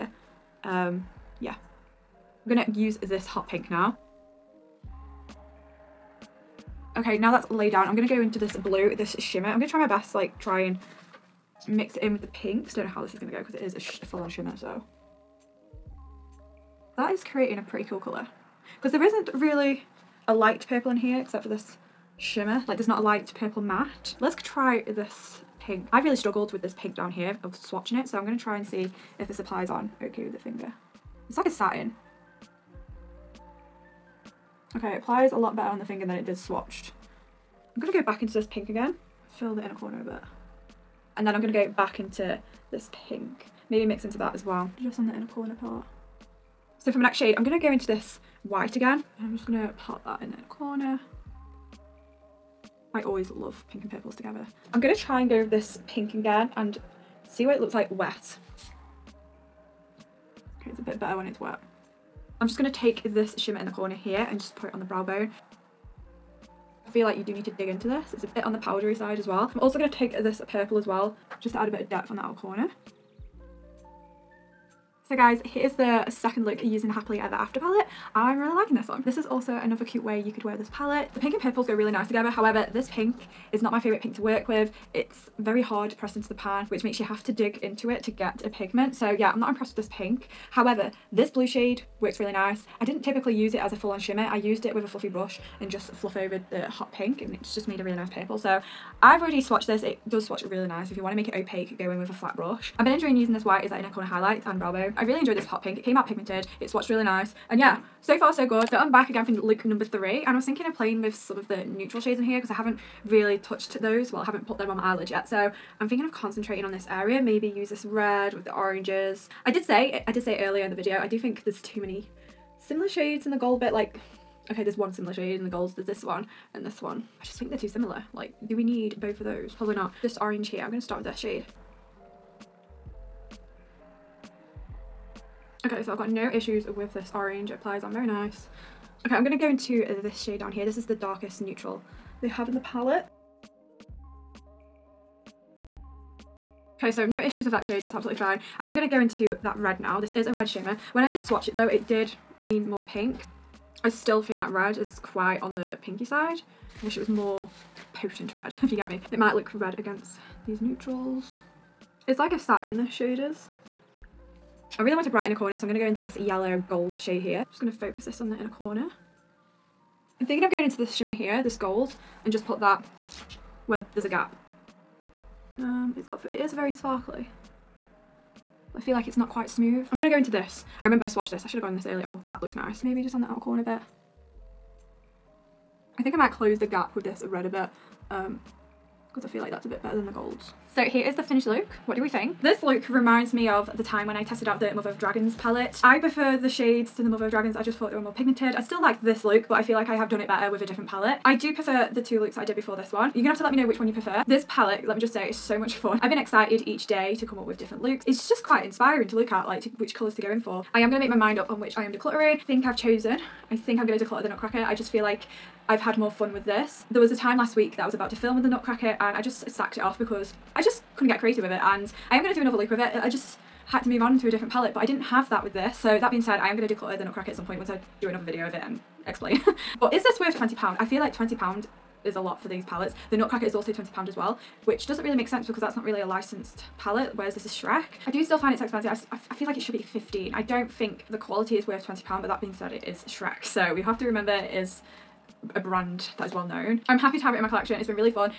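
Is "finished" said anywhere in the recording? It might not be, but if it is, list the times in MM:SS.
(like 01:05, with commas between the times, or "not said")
03:11.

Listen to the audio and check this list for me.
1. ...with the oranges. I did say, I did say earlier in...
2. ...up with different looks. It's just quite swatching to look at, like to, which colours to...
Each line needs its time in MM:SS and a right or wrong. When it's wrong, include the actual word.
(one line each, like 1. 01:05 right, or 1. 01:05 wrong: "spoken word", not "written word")
1. 01:58 right
2. 03:27 wrong: "inspiring", not "swatching".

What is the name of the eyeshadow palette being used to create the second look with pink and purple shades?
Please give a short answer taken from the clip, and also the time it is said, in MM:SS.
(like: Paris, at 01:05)
Happily Ever After, at 01:16.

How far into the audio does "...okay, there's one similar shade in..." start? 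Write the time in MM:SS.
02:04.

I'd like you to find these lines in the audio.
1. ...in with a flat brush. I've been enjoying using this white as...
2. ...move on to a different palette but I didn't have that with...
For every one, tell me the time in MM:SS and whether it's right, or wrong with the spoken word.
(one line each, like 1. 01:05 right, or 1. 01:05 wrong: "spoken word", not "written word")
1. 01:41 right
2. 03:43 right.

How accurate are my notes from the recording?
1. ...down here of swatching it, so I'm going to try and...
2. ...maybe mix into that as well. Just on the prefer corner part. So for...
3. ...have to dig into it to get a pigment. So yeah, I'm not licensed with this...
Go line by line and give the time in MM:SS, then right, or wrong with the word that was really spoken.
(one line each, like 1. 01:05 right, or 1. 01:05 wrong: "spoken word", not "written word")
1. 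00:26 right
2. 00:43 wrong: "inner", not "prefer"
3. 01:27 wrong: "impressed", not "licensed".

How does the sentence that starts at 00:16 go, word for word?
That is creating a pretty cool colour.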